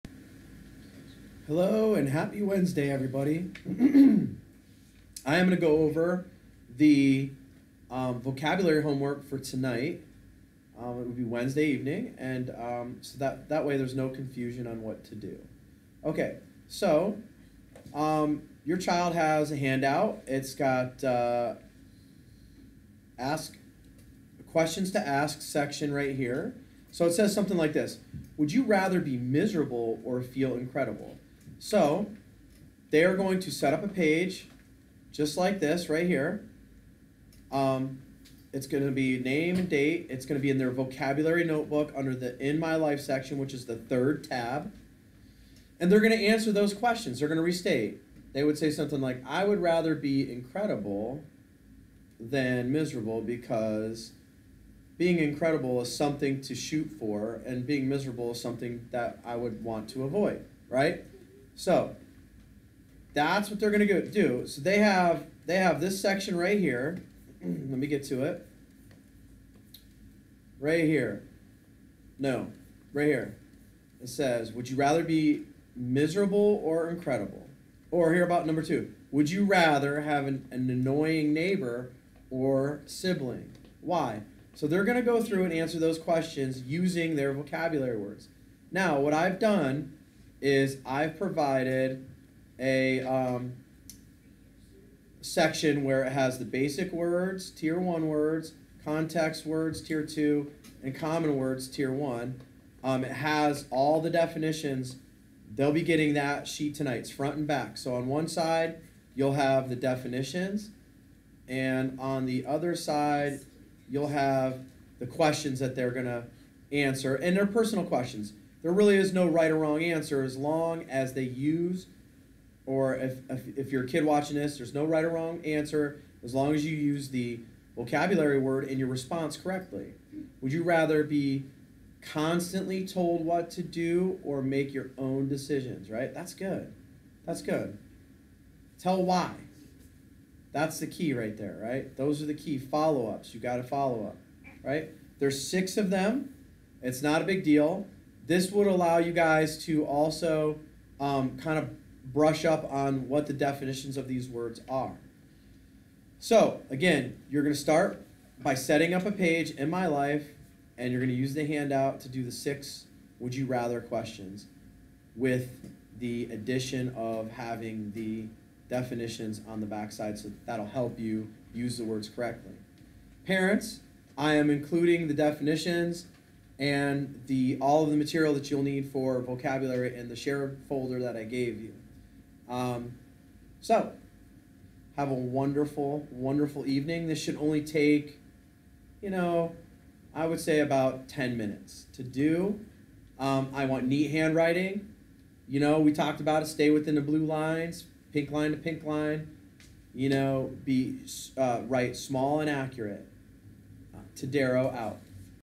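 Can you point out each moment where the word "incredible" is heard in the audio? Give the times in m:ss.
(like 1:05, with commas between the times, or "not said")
0:30, 0:50, 0:55, 1:16.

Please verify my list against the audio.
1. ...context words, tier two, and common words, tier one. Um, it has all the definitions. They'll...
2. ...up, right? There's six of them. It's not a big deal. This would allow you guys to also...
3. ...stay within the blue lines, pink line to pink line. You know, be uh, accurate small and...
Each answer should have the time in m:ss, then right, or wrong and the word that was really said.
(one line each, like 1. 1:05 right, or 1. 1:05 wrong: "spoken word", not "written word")
1. 1:38 right
2. 2:24 right
3. 3:16 wrong: "write", not "accurate".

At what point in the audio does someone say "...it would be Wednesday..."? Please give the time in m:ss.
0:10.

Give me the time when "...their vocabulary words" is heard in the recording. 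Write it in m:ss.
1:27.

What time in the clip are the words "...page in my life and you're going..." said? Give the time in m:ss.
2:39.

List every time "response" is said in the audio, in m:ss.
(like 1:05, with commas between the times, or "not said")
2:08.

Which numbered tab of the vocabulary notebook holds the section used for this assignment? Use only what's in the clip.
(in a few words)
third.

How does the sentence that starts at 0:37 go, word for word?
Um, it's going to be name and date.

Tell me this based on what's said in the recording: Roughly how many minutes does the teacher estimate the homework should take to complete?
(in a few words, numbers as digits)
10.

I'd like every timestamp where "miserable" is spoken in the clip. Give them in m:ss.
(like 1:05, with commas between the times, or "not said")
0:29, 0:52, 0:57, 1:15.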